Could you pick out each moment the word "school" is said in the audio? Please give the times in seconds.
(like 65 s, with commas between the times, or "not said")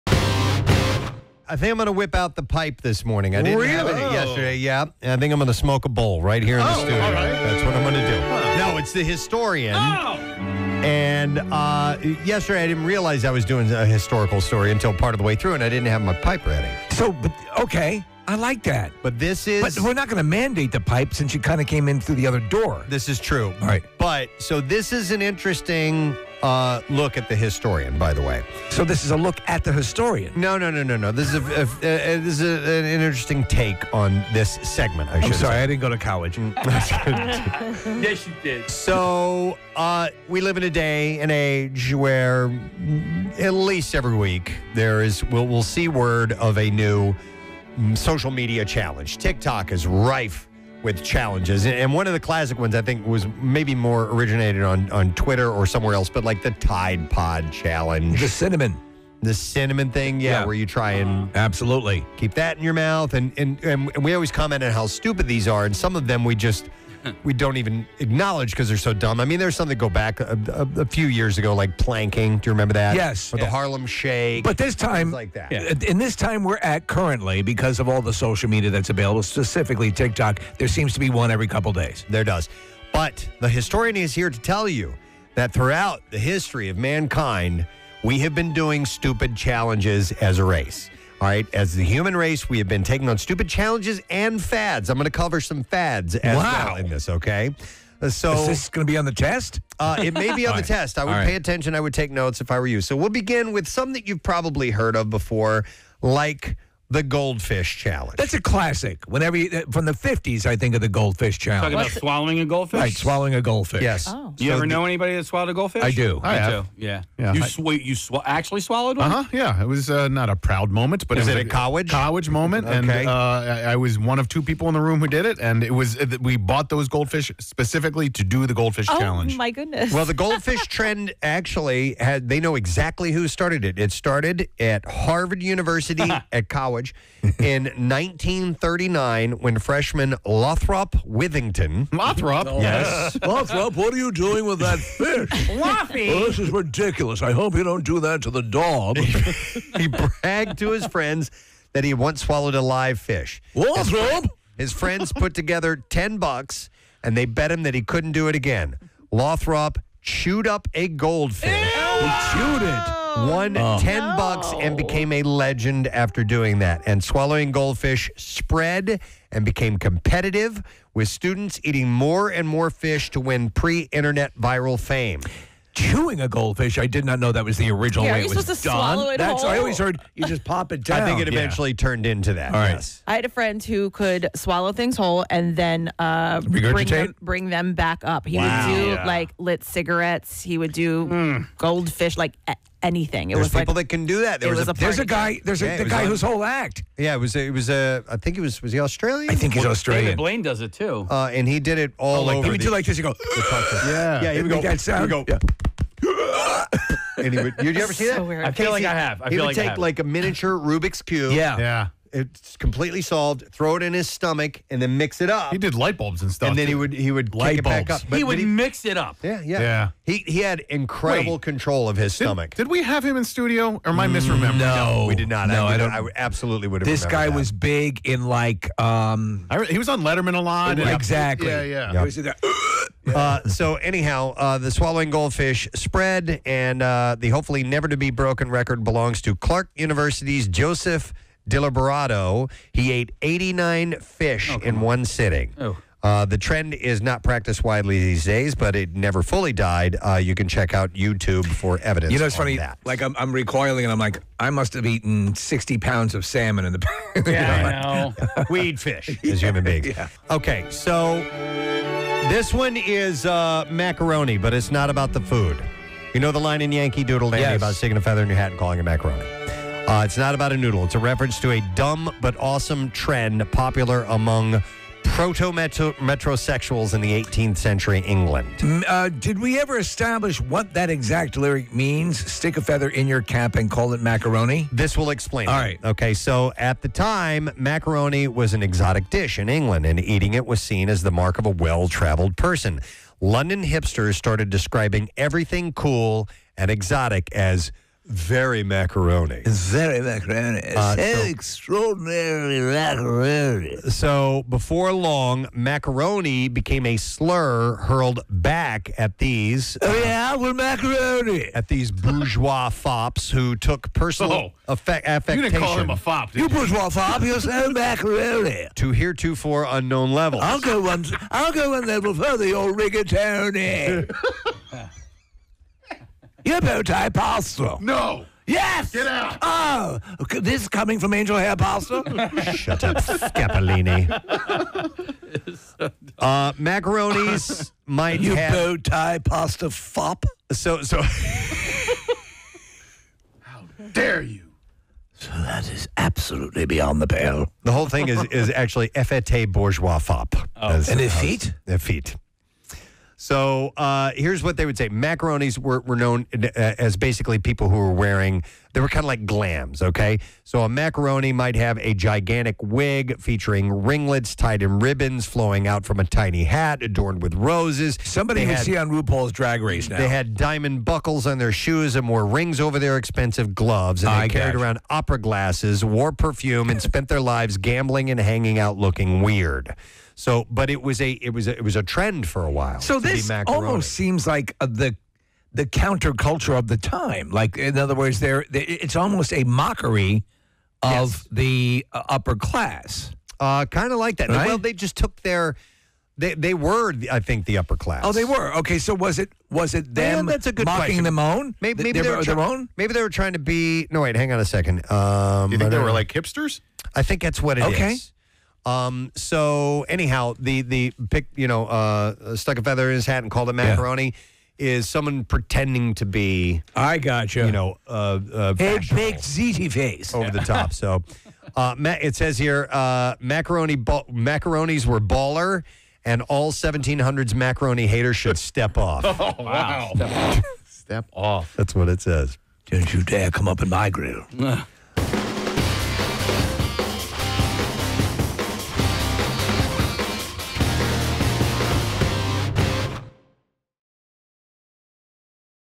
not said.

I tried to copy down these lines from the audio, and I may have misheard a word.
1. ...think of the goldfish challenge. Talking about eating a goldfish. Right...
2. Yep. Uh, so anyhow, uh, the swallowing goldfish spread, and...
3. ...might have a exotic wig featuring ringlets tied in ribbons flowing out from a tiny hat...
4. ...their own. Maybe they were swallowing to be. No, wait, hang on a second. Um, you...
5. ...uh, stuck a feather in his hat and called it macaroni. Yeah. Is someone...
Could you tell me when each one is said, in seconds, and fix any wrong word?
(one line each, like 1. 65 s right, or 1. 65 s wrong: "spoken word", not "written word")
1. 110 s wrong: "swallowing", not "eating"
2. 232 s right
3. 361 s wrong: "gigantic", not "exotic"
4. 402 s wrong: "trying", not "swallowing"
5. 411 s right.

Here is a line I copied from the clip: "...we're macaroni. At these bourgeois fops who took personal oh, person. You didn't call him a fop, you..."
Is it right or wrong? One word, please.
wrong.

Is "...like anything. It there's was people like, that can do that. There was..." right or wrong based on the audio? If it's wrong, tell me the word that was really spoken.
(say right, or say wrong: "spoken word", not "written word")
right.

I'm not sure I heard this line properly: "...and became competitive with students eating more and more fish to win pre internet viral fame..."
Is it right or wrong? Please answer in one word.
right.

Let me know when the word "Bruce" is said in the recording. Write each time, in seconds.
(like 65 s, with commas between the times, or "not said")
not said.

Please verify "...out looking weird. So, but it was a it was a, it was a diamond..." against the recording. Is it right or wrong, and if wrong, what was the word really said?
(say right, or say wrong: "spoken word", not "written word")
wrong: "trend", not "diamond".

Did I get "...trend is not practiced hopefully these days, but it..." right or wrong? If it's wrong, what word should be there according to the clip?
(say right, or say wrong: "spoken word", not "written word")
wrong: "widely", not "hopefully".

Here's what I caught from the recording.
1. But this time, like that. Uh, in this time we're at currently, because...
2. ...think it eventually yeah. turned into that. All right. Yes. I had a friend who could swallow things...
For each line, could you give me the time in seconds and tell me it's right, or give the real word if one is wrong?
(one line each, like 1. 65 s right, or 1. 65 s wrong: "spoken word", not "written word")
1. 74 s right
2. 181 s right.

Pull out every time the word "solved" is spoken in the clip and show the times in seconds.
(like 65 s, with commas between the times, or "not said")
213 s.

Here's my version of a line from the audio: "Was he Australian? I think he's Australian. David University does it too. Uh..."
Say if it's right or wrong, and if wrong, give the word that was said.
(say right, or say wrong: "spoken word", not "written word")
wrong: "Blaine", not "University".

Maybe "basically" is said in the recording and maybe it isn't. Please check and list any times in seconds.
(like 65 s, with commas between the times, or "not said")
356 s.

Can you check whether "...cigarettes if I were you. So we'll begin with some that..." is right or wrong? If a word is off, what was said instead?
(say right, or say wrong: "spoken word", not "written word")
wrong: "notes", not "cigarettes".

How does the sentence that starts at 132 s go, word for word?
They know exactly who started it.